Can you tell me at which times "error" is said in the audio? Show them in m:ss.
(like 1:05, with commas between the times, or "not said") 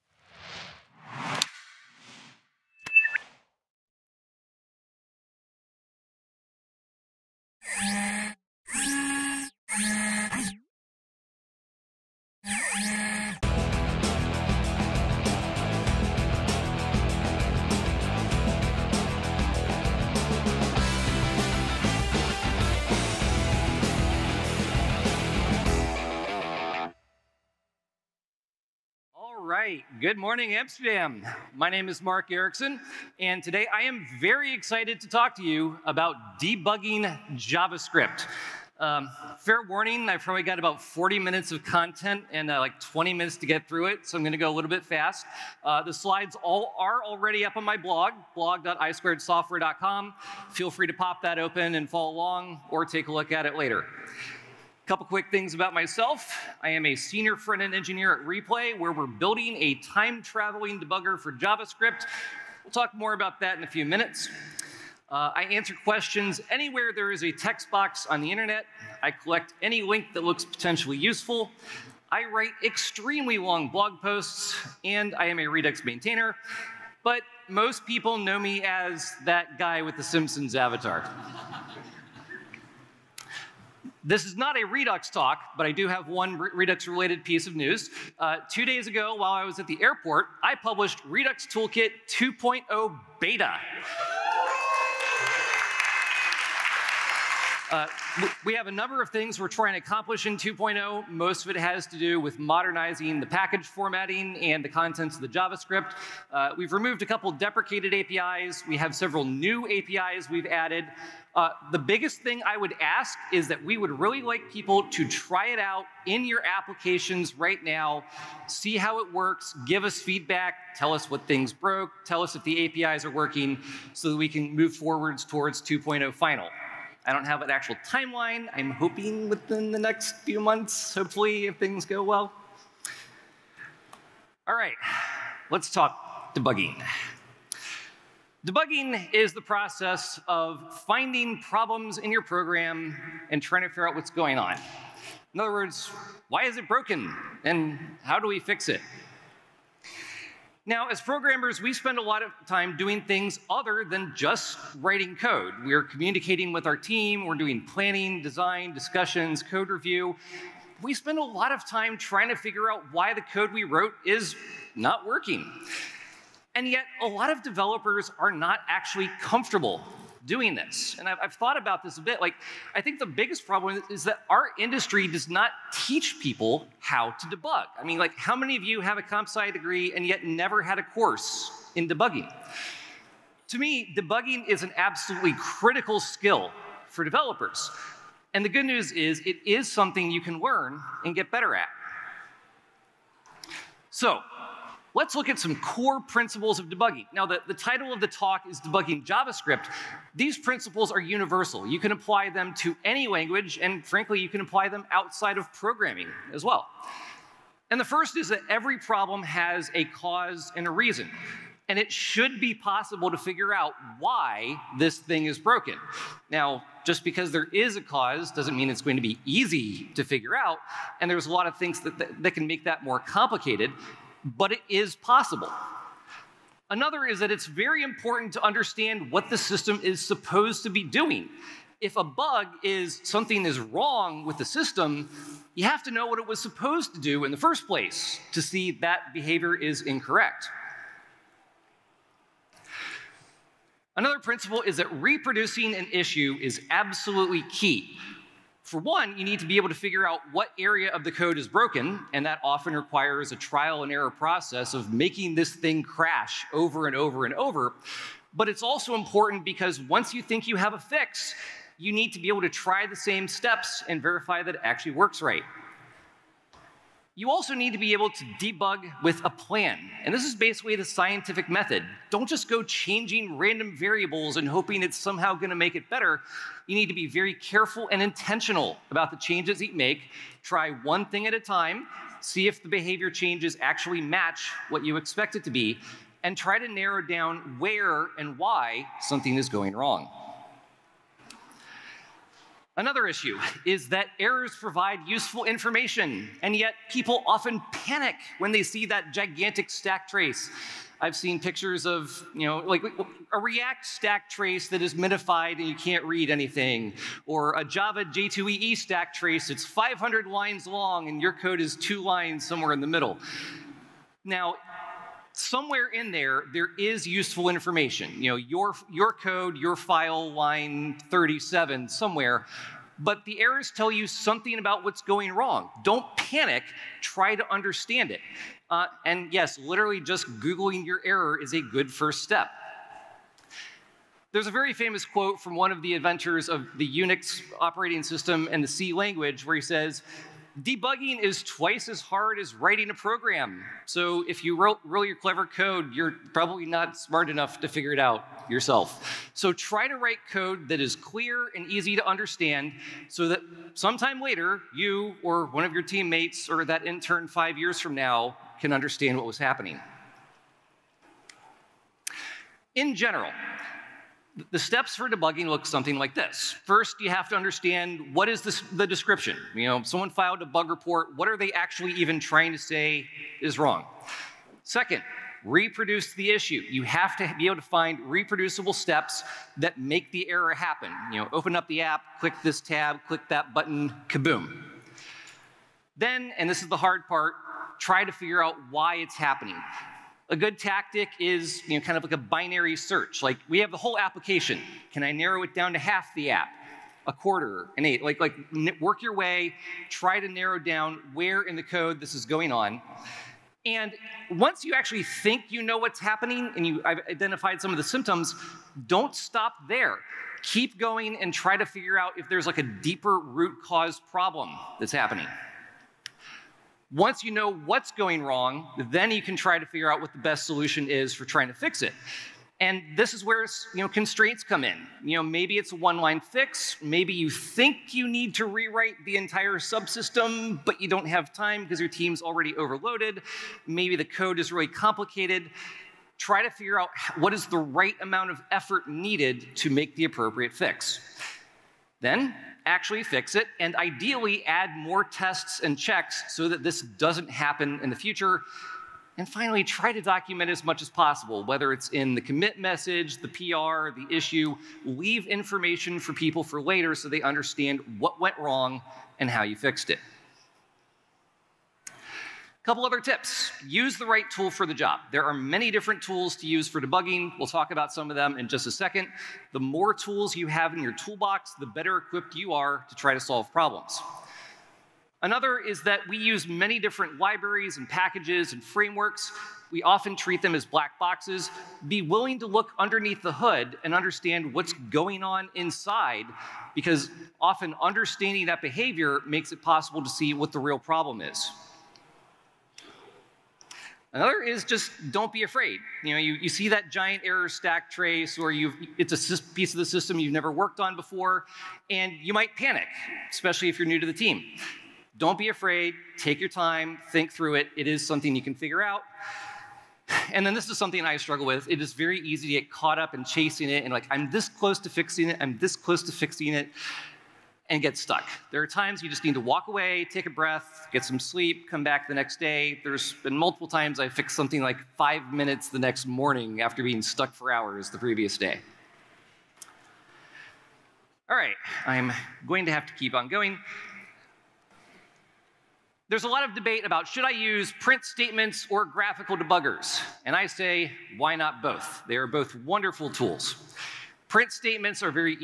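4:13, 4:54, 5:23, 5:31, 6:20, 8:17.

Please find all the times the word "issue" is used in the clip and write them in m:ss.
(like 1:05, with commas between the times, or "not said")
4:05, 4:53, 6:16, 7:34.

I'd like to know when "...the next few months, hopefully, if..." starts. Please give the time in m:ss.
2:09.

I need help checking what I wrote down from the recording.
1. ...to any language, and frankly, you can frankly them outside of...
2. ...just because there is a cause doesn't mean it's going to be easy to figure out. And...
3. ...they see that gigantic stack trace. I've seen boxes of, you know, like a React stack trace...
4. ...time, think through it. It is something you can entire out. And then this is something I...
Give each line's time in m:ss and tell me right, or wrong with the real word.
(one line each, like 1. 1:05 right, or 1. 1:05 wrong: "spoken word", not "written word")
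1. 3:22 wrong: "apply", not "frankly"
2. 3:36 right
3. 4:58 wrong: "pictures", not "boxes"
4. 8:26 wrong: "figure", not "entire".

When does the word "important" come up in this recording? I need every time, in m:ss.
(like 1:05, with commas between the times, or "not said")
3:47, 4:18.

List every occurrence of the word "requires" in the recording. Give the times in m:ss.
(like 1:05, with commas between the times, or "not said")
4:12.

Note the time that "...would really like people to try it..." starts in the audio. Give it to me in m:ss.
1:53.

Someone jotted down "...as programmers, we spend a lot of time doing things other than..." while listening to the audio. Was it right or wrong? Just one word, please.
right.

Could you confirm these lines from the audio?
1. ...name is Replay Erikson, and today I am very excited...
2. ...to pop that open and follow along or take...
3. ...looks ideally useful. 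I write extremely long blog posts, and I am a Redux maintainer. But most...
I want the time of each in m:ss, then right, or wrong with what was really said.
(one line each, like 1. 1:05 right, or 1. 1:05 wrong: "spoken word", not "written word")
1. 0:31 wrong: "Mark", not "Replay"
2. 0:50 right
3. 1:10 wrong: "potentially", not "ideally".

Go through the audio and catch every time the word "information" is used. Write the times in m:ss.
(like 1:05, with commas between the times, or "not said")
4:55, 5:17, 7:35.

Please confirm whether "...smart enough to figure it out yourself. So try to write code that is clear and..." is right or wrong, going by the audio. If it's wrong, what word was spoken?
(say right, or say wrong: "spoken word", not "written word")
right.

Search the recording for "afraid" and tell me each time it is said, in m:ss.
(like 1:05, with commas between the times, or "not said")
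8:15, 8:25.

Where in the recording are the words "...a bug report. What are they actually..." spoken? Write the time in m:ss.
6:10.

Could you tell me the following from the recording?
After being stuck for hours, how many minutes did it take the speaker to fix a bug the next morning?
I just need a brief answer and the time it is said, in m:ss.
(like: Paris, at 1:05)
5, at 8:44.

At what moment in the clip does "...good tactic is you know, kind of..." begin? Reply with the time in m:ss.
6:30.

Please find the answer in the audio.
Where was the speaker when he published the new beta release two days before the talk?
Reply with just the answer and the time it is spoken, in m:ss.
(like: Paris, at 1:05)
At the airport, at 1:29.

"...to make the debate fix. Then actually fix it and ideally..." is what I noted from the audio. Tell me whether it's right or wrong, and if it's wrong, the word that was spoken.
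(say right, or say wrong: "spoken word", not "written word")
wrong: "appropriate", not "debate".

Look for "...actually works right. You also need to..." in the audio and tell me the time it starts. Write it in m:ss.
4:24.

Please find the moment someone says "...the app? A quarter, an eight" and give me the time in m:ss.
6:36.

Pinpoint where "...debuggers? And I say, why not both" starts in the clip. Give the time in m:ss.
8:59.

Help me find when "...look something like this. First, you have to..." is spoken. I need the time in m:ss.
6:05.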